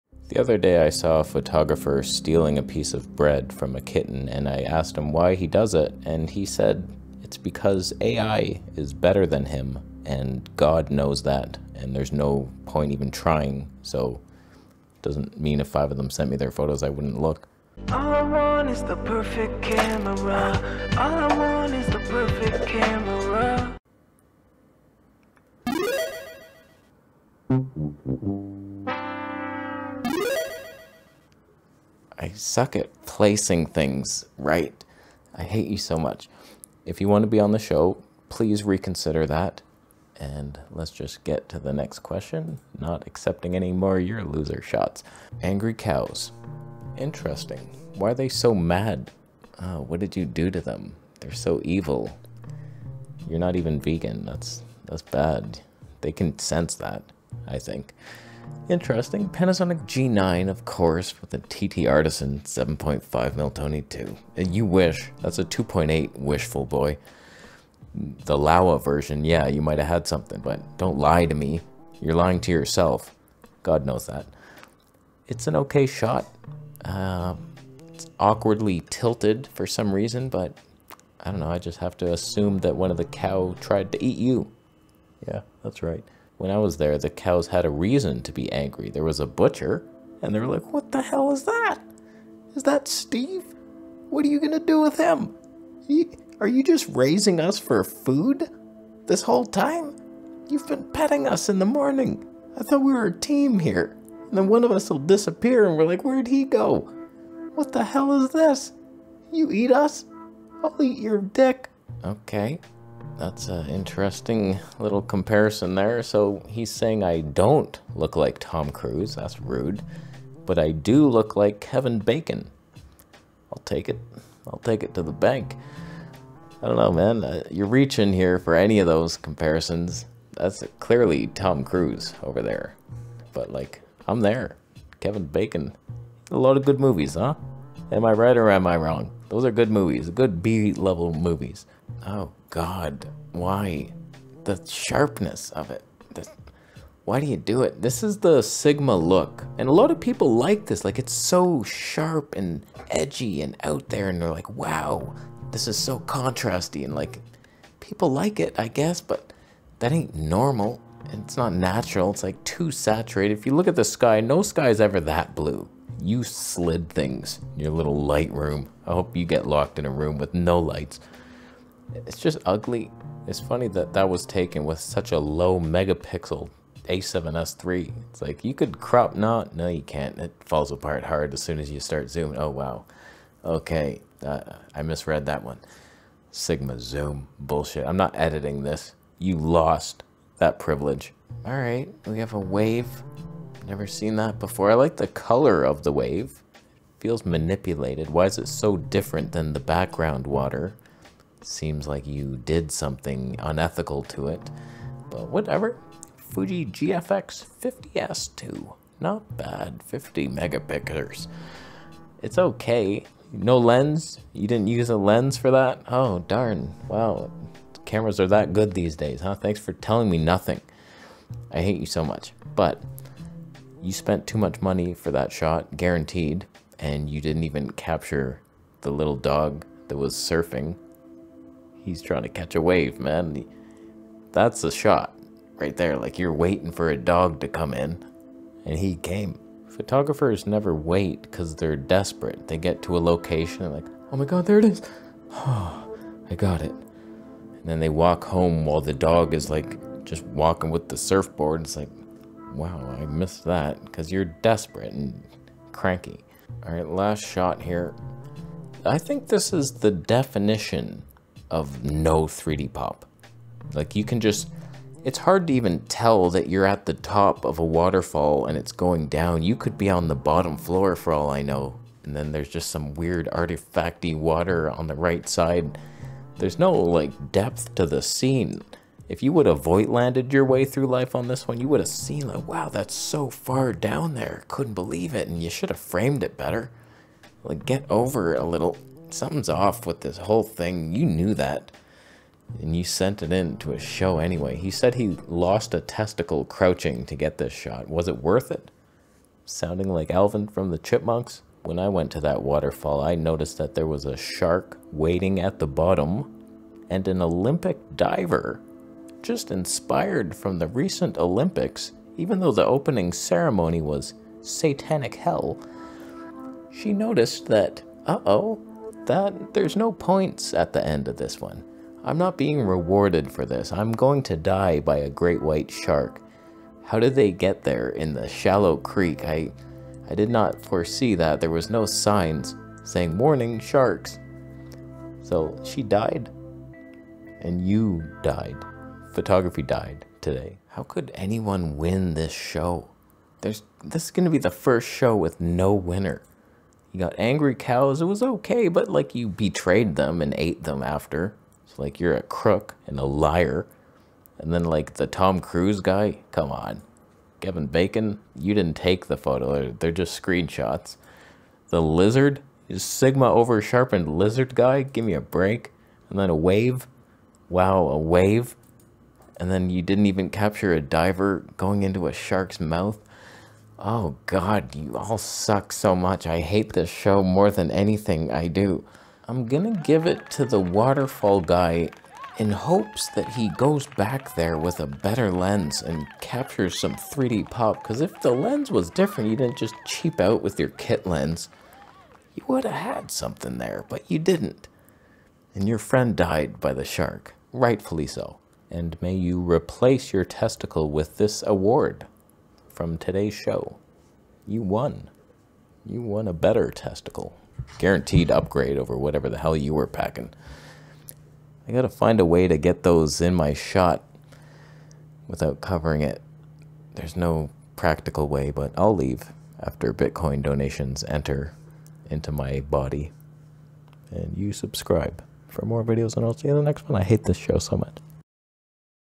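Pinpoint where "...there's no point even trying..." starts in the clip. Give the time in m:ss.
0:11.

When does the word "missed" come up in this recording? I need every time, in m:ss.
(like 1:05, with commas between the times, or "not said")
4:13.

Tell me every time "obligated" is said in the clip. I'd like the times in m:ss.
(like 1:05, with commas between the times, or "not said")
not said.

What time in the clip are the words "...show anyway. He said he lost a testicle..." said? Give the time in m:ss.
4:53.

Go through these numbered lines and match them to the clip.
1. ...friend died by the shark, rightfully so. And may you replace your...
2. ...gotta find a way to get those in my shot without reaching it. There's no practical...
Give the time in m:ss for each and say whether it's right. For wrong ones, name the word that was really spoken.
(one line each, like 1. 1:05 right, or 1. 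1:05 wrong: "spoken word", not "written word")
1. 6:35 right
2. 6:51 wrong: "covering", not "reaching".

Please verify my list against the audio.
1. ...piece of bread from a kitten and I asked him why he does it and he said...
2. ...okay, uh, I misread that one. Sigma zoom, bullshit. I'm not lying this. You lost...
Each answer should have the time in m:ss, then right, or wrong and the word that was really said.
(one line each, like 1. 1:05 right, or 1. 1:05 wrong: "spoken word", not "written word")
1. 0:02 right
2. 3:03 wrong: "editing", not "lying".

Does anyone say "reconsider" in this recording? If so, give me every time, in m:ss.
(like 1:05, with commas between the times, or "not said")
0:38.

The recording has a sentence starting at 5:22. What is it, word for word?
I'm not being rewarded for this.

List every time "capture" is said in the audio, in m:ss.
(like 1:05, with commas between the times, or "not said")
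3:47, 6:10, 6:26.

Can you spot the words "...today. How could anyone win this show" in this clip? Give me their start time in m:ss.
5:40.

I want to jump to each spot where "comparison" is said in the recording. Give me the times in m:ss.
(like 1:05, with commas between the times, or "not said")
1:55, 2:09.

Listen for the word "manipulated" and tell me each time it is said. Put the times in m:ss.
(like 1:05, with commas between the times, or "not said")
3:17.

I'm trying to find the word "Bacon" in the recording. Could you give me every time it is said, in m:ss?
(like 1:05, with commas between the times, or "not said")
2:01, 2:15, 5:57.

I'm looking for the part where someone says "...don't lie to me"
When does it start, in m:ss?
1:10.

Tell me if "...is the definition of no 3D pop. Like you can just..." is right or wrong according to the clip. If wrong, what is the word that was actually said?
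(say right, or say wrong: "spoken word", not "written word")
right.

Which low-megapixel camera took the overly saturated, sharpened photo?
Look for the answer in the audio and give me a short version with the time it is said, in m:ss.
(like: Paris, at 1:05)
A7S3, at 2:56.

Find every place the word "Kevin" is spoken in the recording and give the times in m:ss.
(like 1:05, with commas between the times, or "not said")
2:01, 2:14, 5:57.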